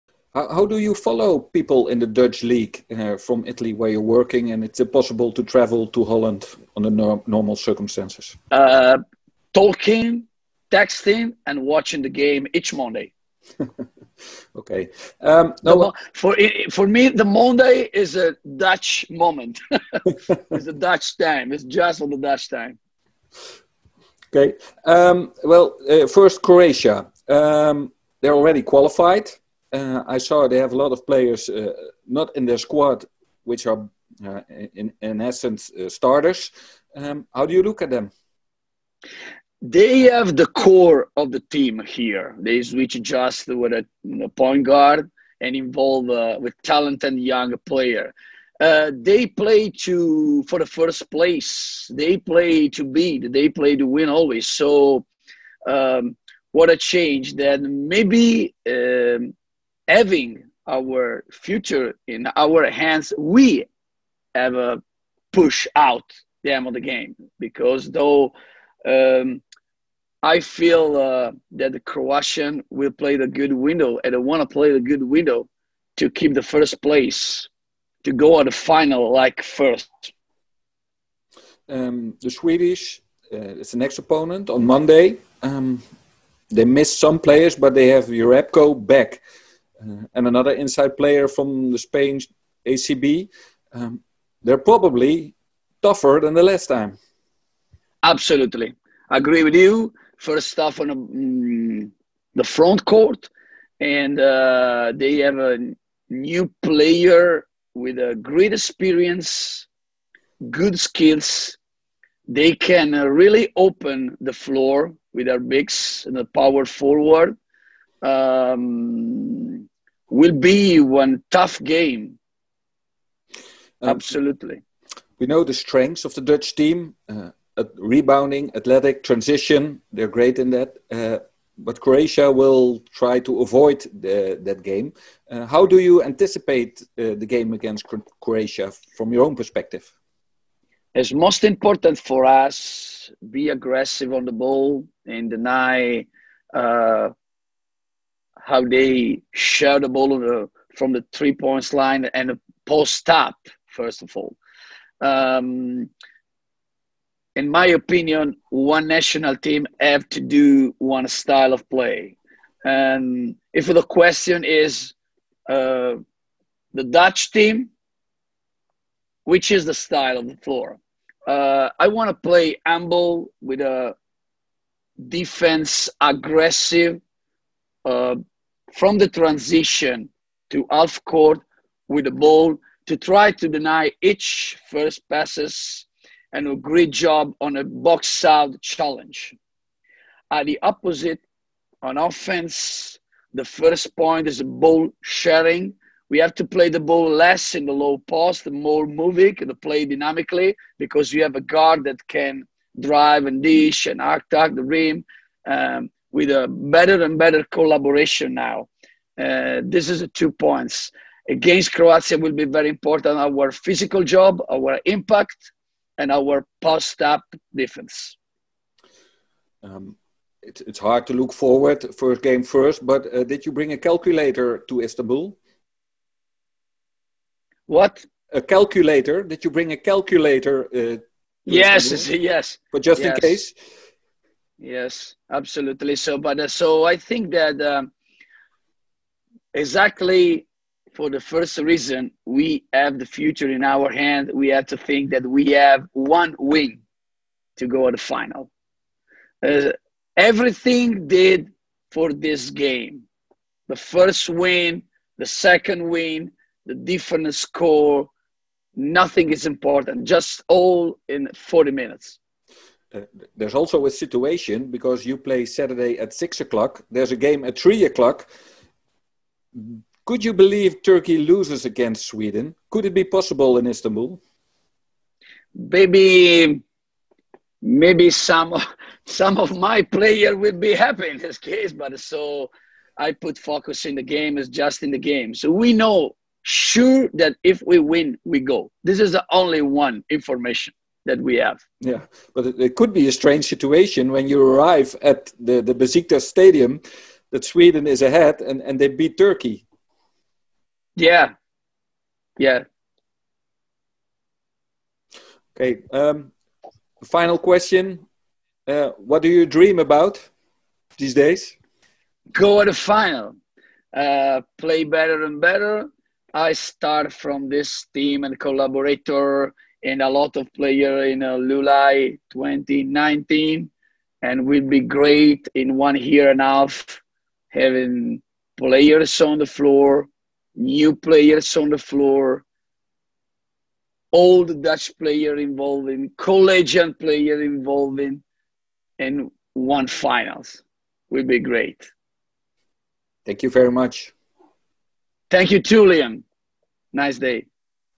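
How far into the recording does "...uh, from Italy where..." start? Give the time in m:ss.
0:02.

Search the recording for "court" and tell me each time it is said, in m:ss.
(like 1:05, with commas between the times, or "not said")
1:42, 3:01.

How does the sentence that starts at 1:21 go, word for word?
Um, the Swedish uh, it's the next opponent on Monday.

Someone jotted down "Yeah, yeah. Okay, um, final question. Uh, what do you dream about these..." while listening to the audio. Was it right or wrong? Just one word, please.
right.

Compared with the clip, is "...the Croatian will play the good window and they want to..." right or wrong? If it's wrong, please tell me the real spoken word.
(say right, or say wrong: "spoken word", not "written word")
right.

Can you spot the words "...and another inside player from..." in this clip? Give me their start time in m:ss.
1:30.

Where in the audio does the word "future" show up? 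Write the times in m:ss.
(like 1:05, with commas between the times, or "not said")
1:01, 4:03.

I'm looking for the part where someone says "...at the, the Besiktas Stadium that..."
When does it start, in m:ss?
4:55.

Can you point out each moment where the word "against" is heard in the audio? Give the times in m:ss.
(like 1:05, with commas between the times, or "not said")
2:17, 3:31, 4:31.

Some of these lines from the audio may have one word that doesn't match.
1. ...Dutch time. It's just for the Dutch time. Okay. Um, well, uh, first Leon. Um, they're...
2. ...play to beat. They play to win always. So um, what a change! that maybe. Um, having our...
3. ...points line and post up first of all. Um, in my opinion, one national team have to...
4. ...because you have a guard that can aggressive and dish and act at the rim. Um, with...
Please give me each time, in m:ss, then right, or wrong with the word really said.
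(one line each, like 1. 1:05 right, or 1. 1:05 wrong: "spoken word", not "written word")
1. 0:20 wrong: "Croatia", not "Leon"
2. 0:52 right
3. 2:31 right
4. 3:20 wrong: "drive", not "aggressive".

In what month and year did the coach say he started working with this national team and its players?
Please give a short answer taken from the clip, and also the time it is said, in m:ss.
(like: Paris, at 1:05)
July 2019, at 5:21.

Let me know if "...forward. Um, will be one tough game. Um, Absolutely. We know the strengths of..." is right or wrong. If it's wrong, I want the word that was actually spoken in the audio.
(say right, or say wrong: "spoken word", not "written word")
right.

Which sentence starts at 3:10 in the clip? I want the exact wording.
At the opposite, on offense, the first point is a ball sharing.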